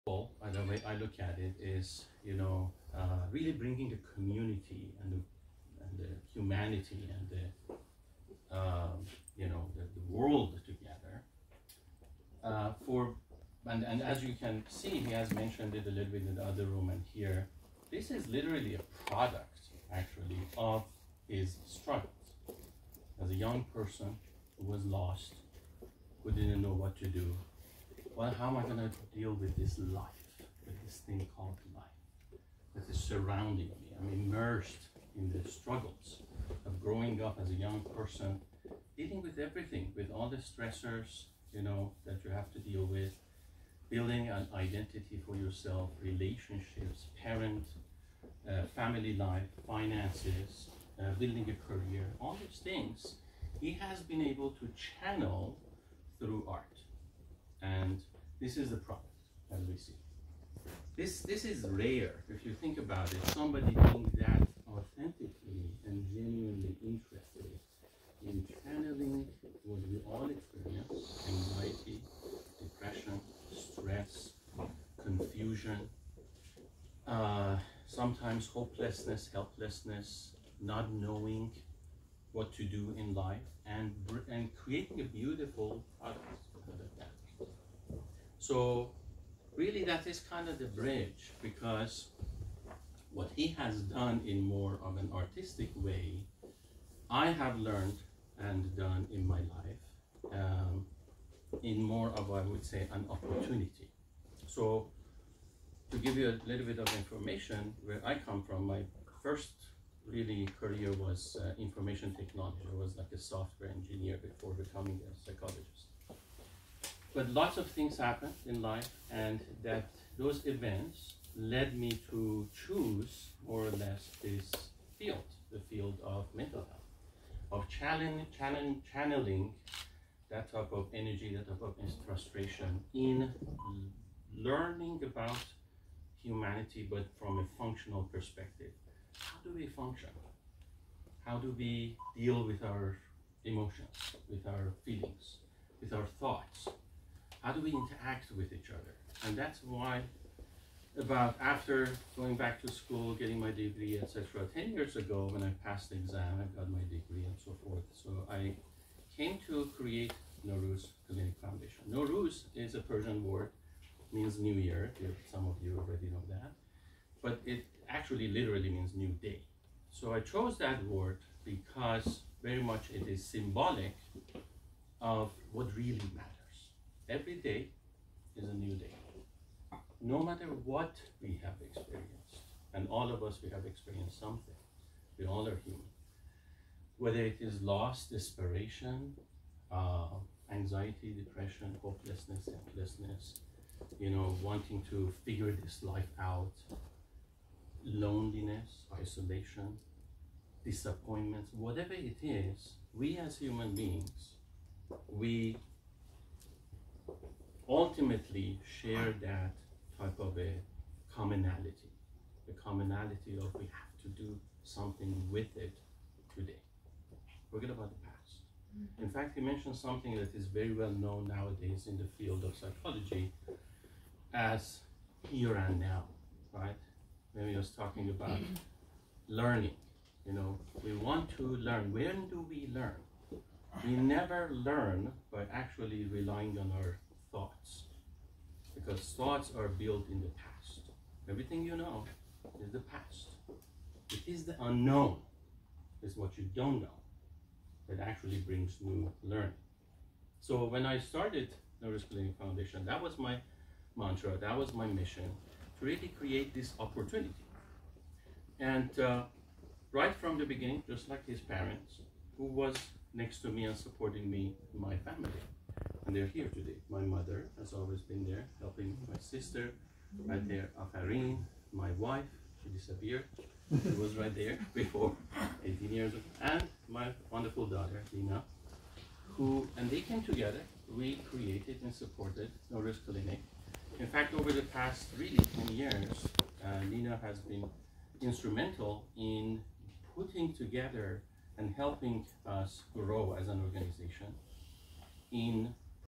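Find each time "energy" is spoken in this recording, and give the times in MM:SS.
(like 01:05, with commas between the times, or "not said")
02:10.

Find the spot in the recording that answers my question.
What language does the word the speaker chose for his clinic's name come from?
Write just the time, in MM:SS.
02:42.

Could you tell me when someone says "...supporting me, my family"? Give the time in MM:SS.
04:23.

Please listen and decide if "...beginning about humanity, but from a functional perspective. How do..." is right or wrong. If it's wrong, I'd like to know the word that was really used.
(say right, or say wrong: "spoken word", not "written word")
wrong: "learning", not "beginning".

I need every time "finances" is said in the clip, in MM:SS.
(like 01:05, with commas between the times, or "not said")
00:49.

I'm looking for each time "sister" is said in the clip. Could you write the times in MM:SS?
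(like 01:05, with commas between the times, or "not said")
04:29.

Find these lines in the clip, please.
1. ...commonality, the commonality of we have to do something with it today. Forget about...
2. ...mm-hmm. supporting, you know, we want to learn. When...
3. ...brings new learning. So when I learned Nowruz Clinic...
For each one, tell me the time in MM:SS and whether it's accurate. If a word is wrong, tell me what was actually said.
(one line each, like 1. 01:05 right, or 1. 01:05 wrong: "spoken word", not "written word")
1. 03:31 right
2. 03:48 wrong: "learning", not "supporting"
3. 04:08 wrong: "started", not "learned".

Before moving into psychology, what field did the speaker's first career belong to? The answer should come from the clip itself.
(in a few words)
Information technology.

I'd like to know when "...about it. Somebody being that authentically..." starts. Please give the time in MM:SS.
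01:02.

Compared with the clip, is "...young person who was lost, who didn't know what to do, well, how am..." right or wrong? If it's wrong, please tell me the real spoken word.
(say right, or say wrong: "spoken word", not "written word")
right.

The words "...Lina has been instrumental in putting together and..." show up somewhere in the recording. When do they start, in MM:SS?
04:46.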